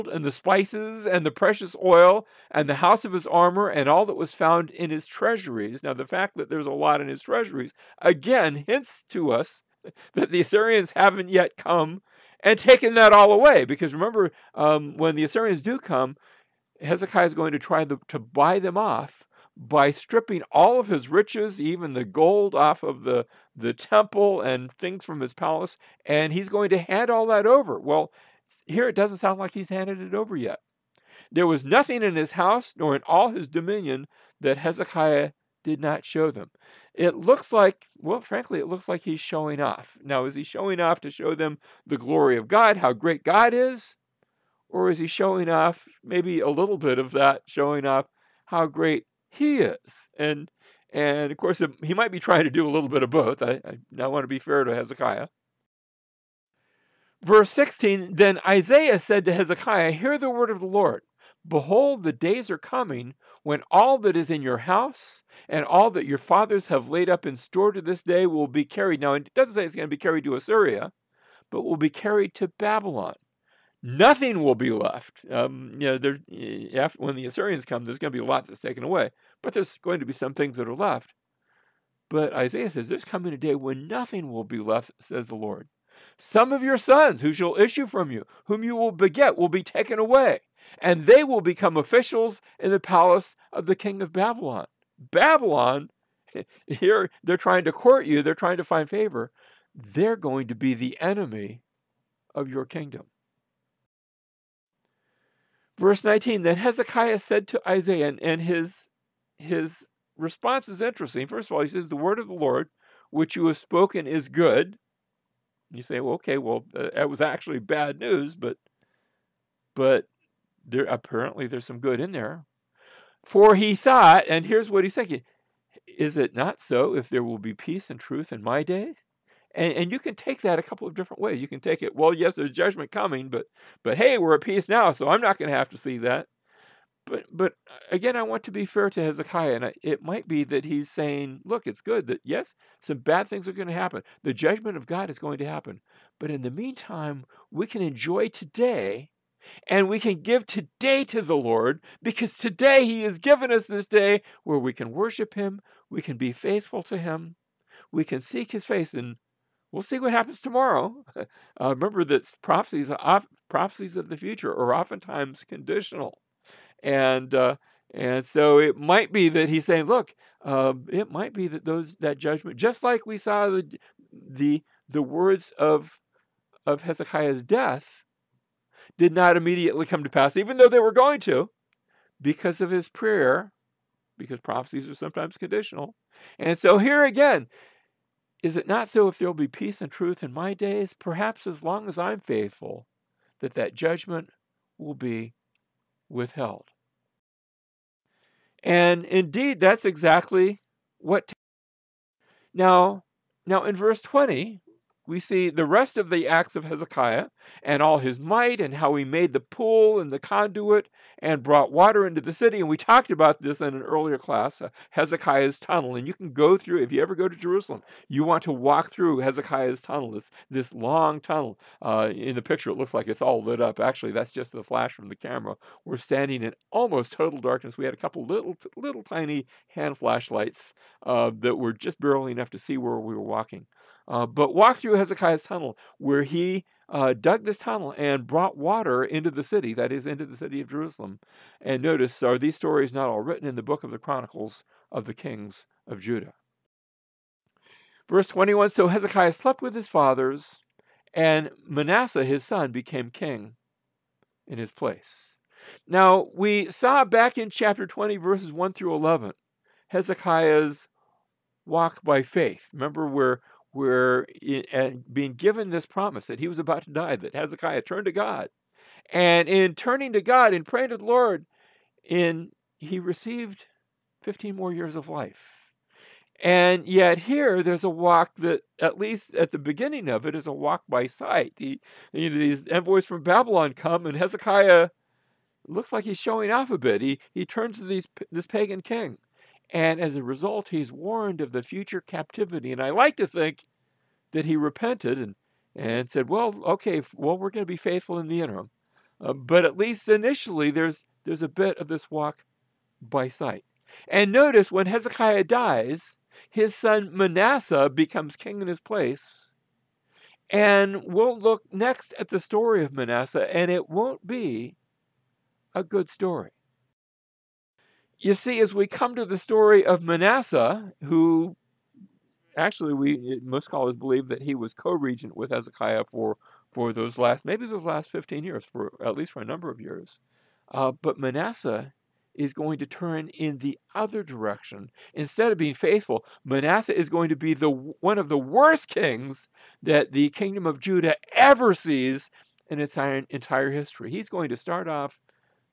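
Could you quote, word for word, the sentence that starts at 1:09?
Now, it doesn't say it's going to be carried to Assyria, but will be carried to Babylon nothing will be left.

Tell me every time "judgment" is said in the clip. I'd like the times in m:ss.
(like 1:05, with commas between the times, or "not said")
2:12, 2:24, 2:52, 3:13.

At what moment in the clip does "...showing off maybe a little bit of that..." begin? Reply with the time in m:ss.
0:45.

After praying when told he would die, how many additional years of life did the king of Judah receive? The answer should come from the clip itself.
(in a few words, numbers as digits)
15.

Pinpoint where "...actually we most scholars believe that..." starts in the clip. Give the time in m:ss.
5:22.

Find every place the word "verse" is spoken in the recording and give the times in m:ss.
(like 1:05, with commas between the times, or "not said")
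0:57, 1:45, 3:23, 4:08, 4:18.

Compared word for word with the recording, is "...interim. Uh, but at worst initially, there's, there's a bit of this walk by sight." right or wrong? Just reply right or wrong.
wrong.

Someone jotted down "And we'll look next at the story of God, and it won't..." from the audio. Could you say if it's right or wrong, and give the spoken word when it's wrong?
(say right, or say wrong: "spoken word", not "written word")
wrong: "Manasseh", not "God".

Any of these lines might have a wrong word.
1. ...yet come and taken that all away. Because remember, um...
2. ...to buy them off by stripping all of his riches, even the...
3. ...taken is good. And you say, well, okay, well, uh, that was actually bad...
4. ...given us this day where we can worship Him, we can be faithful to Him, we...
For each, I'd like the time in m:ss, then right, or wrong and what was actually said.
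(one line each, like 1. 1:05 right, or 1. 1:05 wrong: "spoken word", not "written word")
1. 0:11 right
2. 0:18 right
3. 1:53 wrong: "spoken", not "taken"
4. 2:33 right.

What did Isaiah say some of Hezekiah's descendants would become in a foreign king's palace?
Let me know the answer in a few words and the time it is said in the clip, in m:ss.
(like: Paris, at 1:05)
officials, at 1:31.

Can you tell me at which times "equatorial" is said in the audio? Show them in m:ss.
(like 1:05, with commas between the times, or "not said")
not said.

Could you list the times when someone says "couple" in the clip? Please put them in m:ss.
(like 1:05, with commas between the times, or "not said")
2:10, 3:47.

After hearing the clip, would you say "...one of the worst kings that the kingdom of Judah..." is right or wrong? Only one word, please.
right.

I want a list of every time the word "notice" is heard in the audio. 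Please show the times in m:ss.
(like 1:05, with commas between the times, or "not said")
4:01, 5:04.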